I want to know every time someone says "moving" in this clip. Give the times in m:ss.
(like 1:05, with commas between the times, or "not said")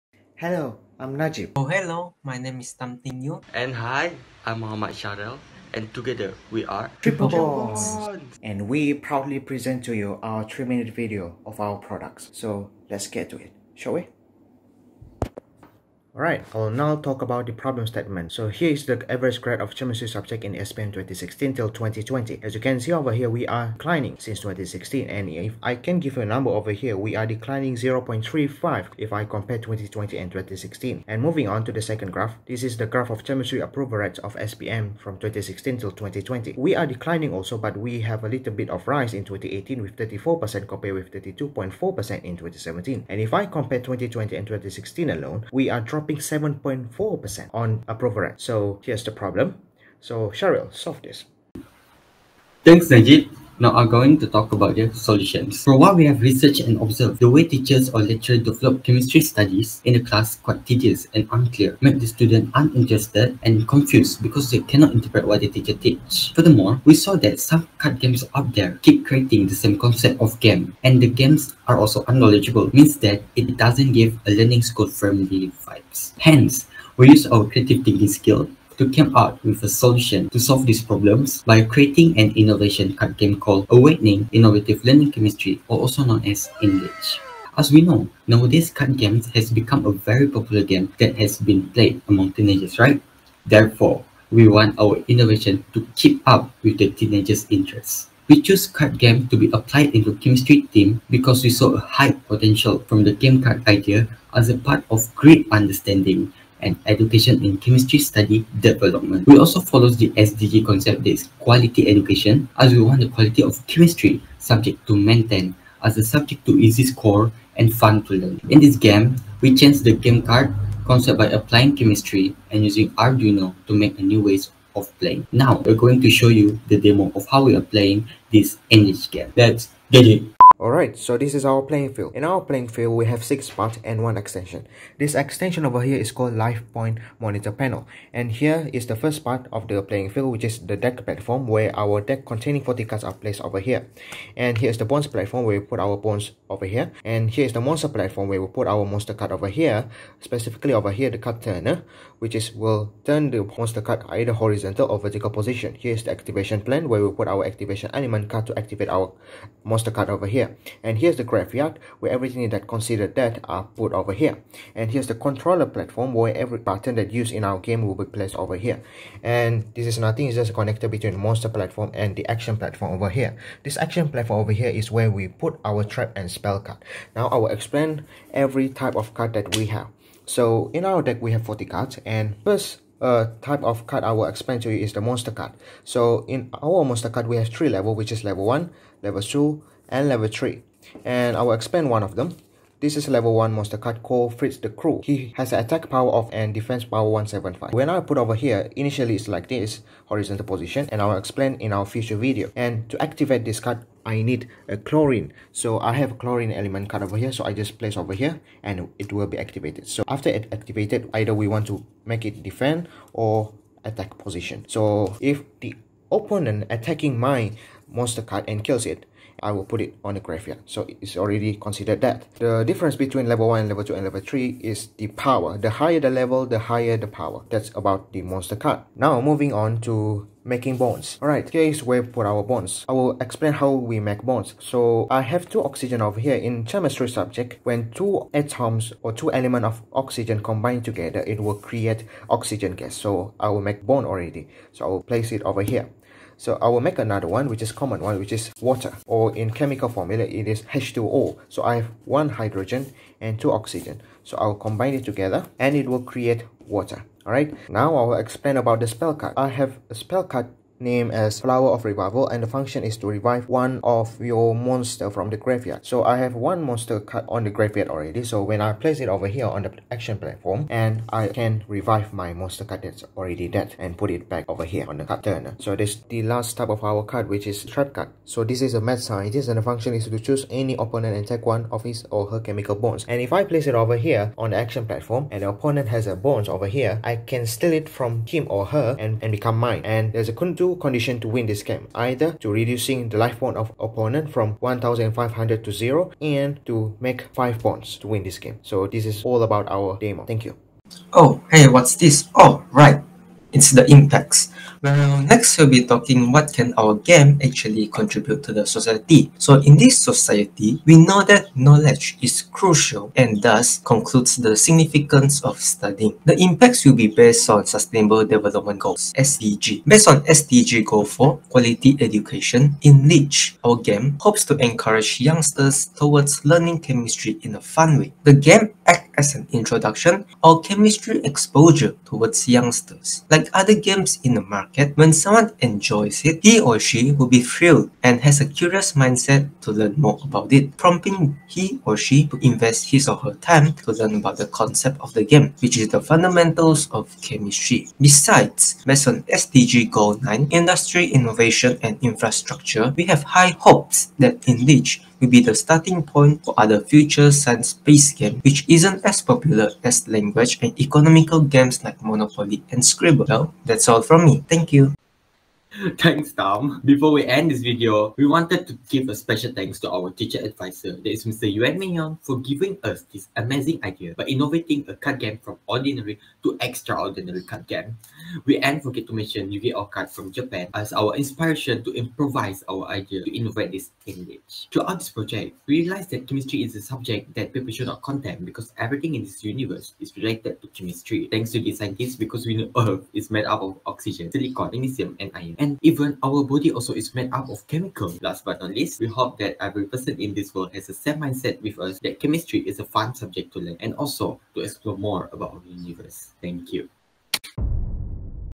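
0:31, 3:49.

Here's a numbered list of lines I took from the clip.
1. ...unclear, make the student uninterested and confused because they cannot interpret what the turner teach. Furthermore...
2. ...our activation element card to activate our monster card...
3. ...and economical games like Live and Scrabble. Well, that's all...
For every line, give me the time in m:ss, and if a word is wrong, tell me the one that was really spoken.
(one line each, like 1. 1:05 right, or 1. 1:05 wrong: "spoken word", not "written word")
1. 1:01 wrong: "teacher", not "turner"
2. 2:37 right
3. 6:00 wrong: "Monopoly", not "Live".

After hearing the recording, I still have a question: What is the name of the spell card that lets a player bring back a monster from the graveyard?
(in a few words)
Flower of Revival.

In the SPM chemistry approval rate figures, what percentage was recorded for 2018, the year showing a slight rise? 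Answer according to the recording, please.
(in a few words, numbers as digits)
34%.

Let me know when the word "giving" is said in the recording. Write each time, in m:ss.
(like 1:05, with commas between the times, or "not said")
6:12.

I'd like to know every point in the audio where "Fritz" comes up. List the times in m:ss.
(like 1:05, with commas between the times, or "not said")
3:14.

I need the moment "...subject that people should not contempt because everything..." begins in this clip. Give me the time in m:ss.
6:26.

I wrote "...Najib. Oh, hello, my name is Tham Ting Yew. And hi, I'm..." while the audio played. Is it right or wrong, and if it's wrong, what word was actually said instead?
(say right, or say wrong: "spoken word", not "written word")
right.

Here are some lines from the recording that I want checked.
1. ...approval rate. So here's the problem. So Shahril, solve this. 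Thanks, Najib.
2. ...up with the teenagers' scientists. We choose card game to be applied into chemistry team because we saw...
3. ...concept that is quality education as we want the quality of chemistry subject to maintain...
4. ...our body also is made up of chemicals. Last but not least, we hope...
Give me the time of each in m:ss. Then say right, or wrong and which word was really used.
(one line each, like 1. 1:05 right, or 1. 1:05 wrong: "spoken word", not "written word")
1. 0:47 right
2. 1:36 wrong: "interests", not "scientists"
3. 1:50 right
4. 6:36 right.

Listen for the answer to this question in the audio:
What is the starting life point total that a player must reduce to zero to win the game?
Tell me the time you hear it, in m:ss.
4:54.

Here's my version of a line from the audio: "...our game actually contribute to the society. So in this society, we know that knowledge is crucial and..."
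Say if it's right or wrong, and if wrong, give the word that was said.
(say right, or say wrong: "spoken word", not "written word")
right.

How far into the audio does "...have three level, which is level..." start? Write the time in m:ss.
3:07.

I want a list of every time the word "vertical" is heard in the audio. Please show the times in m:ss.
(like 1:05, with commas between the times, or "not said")
2:34.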